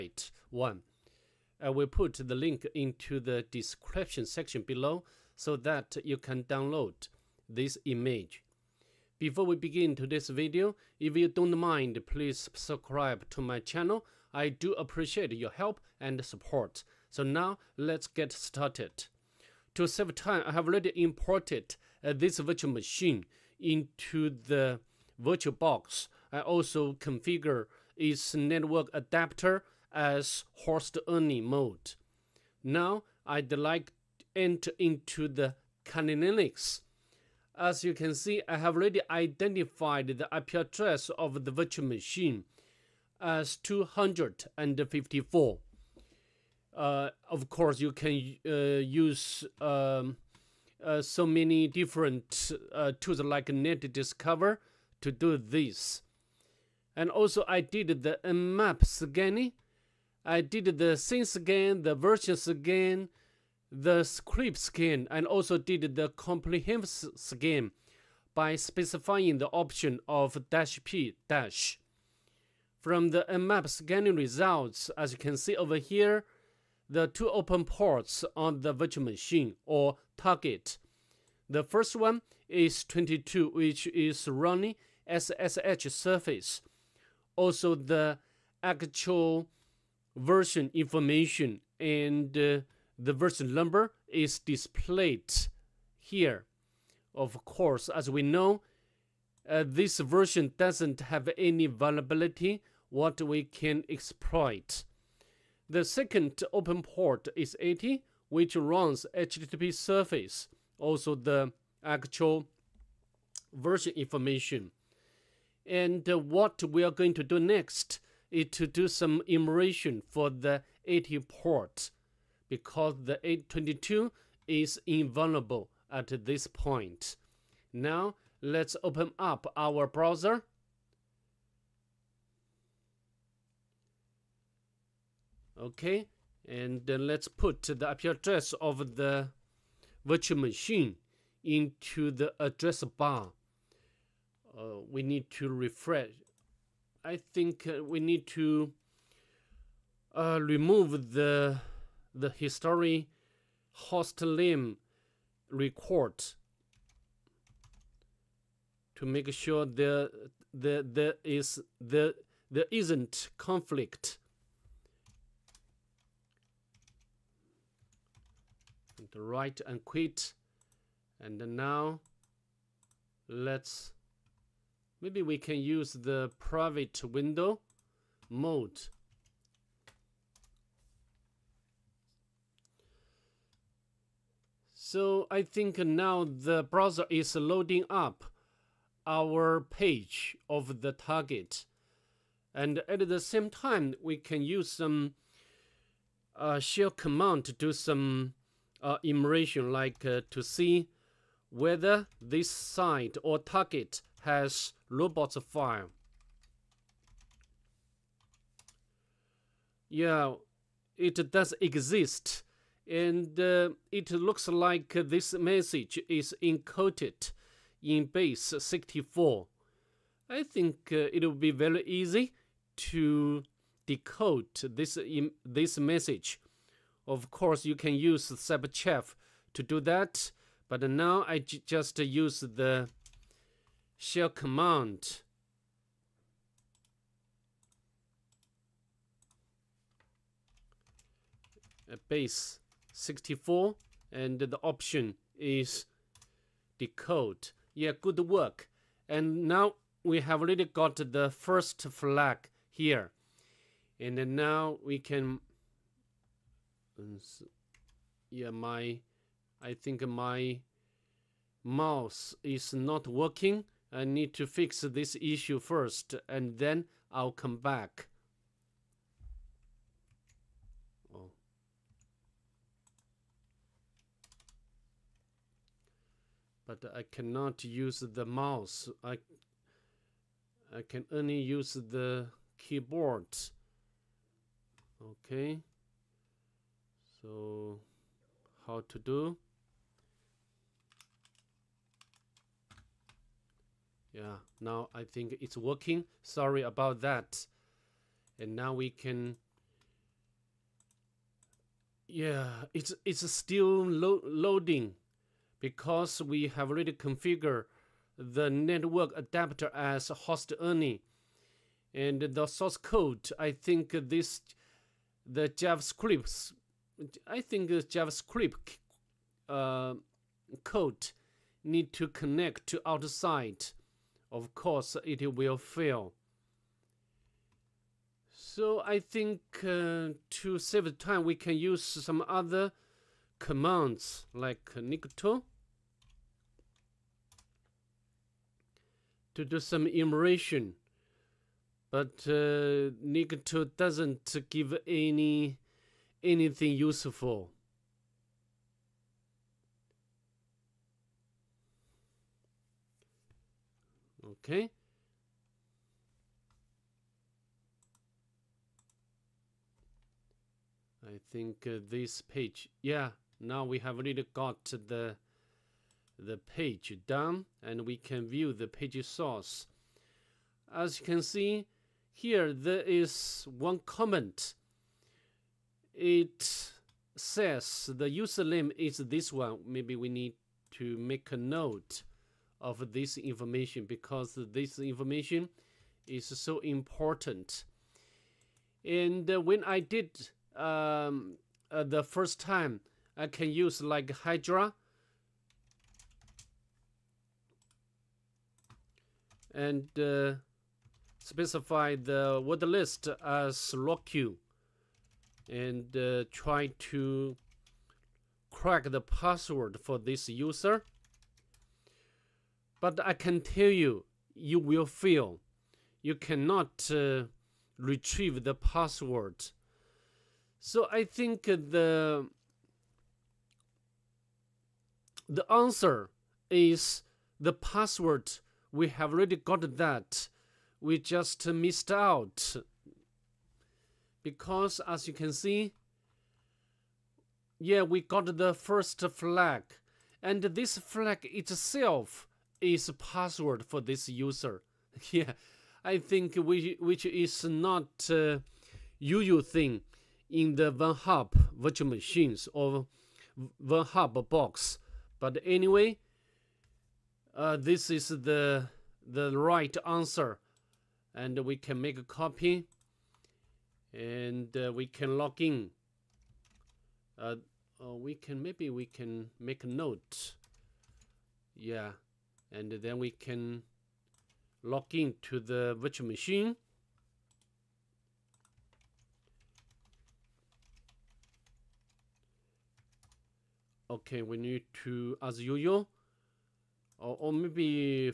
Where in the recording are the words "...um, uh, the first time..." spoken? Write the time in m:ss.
6:30.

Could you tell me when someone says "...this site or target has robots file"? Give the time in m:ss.
3:22.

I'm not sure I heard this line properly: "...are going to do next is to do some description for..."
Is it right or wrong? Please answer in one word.
wrong.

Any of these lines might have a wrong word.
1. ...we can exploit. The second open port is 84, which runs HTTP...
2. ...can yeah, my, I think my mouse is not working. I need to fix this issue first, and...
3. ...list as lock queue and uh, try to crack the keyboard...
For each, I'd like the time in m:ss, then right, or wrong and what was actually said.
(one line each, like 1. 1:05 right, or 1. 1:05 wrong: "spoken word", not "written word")
1. 1:43 wrong: "80", not "84"
2. 4:14 right
3. 6:42 wrong: "password", not "keyboard".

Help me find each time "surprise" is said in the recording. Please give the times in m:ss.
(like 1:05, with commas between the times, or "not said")
not said.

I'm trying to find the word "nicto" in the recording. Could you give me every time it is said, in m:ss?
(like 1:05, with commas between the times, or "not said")
5:34, 5:43.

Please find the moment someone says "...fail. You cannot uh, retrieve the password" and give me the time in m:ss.
6:54.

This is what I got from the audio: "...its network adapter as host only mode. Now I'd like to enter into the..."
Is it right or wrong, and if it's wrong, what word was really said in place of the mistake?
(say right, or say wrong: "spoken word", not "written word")
right.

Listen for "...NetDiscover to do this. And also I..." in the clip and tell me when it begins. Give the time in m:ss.
0:53.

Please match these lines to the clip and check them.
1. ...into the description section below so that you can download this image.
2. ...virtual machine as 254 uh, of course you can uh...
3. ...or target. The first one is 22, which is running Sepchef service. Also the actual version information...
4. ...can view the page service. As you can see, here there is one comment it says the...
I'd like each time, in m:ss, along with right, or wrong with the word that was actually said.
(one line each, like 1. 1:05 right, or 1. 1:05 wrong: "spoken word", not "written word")
1. 0:02 right
2. 0:41 right
3. 1:19 wrong: "SSH", not "Sepchef"
4. 6:07 wrong: "source", not "service".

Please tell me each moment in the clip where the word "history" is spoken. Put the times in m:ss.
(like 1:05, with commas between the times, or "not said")
2:32.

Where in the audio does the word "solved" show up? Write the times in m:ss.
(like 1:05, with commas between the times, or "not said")
not said.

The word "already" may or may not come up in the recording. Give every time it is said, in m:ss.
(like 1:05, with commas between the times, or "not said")
0:20, 0:38, 4:10, 5:06, 6:03, 7:09.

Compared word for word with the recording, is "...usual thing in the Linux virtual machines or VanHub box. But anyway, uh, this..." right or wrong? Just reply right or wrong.
wrong.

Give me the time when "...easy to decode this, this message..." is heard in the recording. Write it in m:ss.
3:41.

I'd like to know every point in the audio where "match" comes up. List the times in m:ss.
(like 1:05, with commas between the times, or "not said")
not said.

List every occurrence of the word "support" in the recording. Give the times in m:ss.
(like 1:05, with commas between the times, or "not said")
0:16.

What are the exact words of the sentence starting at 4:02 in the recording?
base 64 and the option is decode.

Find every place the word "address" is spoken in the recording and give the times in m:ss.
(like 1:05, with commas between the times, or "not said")
0:40, 2:18, 2:22.